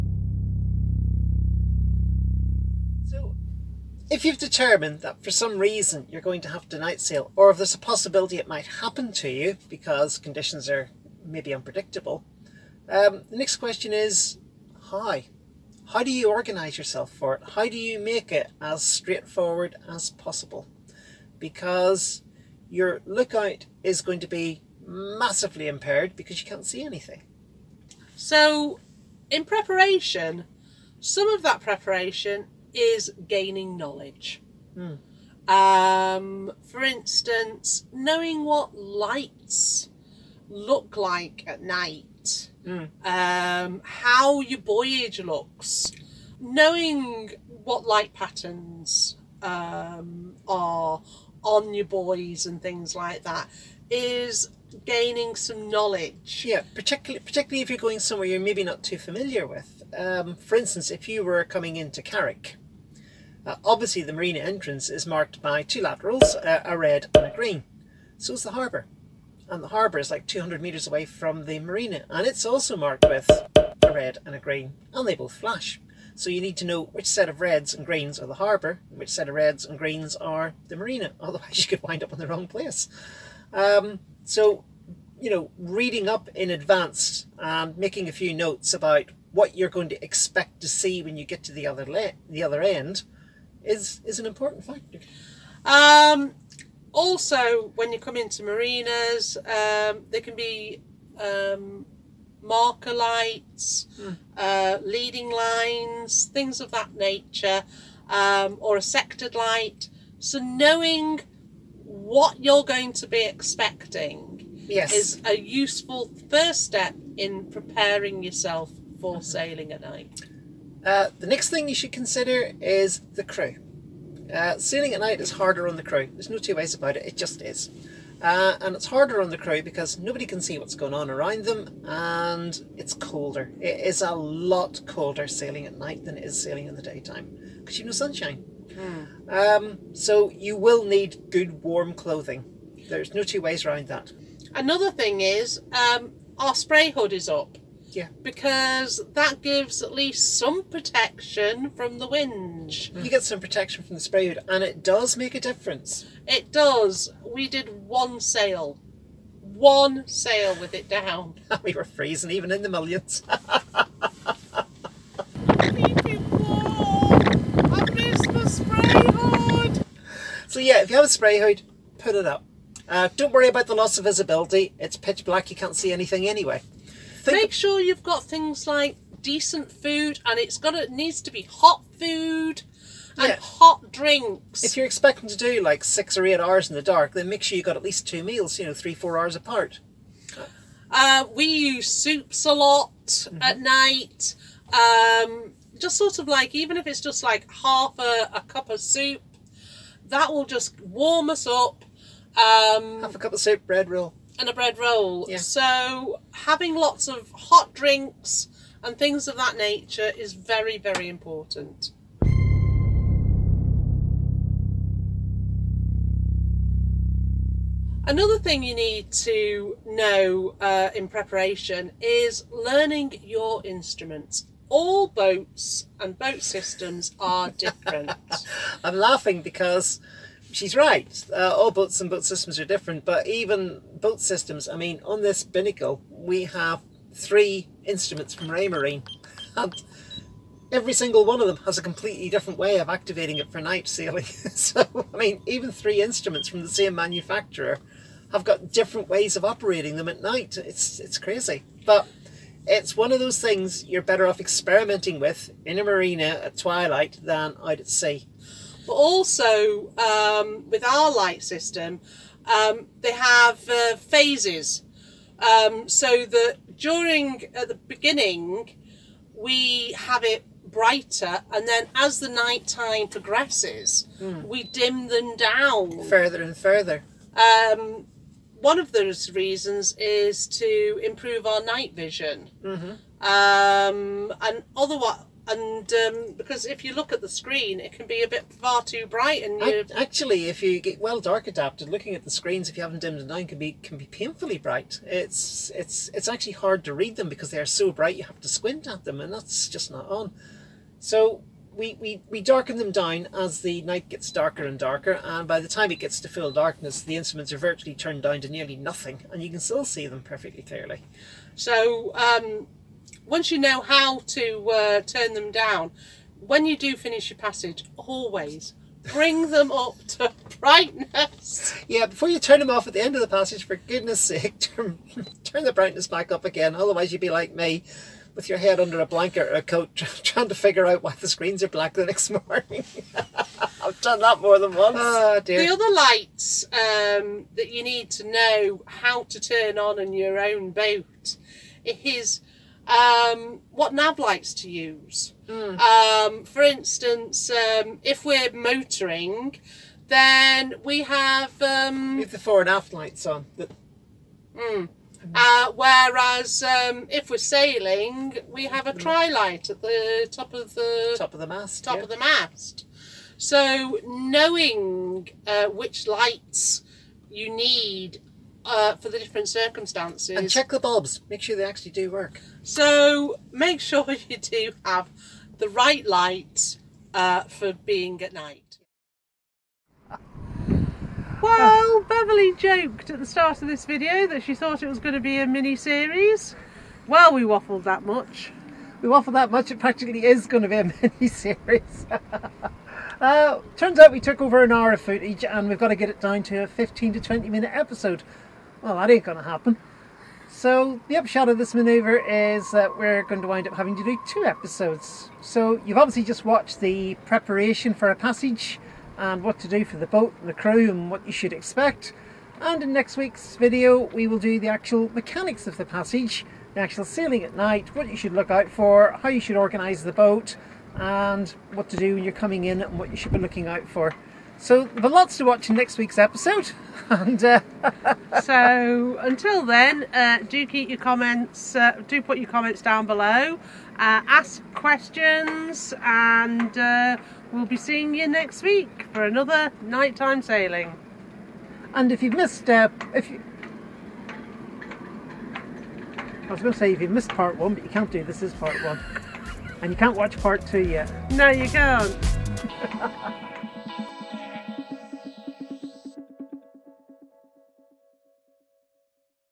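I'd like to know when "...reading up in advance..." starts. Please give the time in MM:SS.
01:25.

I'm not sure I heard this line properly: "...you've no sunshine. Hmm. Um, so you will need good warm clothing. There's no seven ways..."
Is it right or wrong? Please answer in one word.
wrong.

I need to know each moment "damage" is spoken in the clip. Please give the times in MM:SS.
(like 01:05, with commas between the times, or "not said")
not said.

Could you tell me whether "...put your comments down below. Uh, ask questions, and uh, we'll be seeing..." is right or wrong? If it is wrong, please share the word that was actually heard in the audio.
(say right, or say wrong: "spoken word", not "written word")
right.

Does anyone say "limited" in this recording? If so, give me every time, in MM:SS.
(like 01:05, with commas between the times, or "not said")
not said.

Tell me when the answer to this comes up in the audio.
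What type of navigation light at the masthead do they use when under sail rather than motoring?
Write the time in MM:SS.
05:59.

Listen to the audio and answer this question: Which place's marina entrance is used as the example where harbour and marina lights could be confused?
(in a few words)
Carrick.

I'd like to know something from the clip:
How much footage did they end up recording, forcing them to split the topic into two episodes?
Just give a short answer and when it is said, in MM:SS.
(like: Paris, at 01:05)
over an hour, at 06:34.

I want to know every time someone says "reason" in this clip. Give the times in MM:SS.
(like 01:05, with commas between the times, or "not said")
00:05, 04:39.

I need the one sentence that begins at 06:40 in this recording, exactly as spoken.
So the upshot of this manoeuvre is that we're going to wind up having to do two episodes.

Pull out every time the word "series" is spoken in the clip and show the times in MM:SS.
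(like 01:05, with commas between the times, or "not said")
06:25, 06:31.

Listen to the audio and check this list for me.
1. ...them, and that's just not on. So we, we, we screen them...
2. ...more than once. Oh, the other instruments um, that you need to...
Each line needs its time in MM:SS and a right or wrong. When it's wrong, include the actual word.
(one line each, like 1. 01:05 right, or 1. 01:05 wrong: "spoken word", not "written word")
1. 04:59 wrong: "darken", not "screen"
2. 05:34 wrong: "lights", not "instruments".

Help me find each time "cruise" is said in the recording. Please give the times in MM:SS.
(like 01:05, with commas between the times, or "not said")
not said.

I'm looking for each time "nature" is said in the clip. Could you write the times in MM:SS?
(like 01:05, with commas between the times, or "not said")
01:46, 03:29.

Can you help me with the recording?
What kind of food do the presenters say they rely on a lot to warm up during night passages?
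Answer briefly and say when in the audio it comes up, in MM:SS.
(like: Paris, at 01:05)
soups, at 03:11.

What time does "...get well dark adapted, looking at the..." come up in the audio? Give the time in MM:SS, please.
04:50.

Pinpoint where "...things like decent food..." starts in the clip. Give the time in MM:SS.
02:58.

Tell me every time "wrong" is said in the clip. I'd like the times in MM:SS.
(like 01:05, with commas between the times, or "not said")
01:22.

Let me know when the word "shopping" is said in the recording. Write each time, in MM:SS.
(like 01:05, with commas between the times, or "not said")
not said.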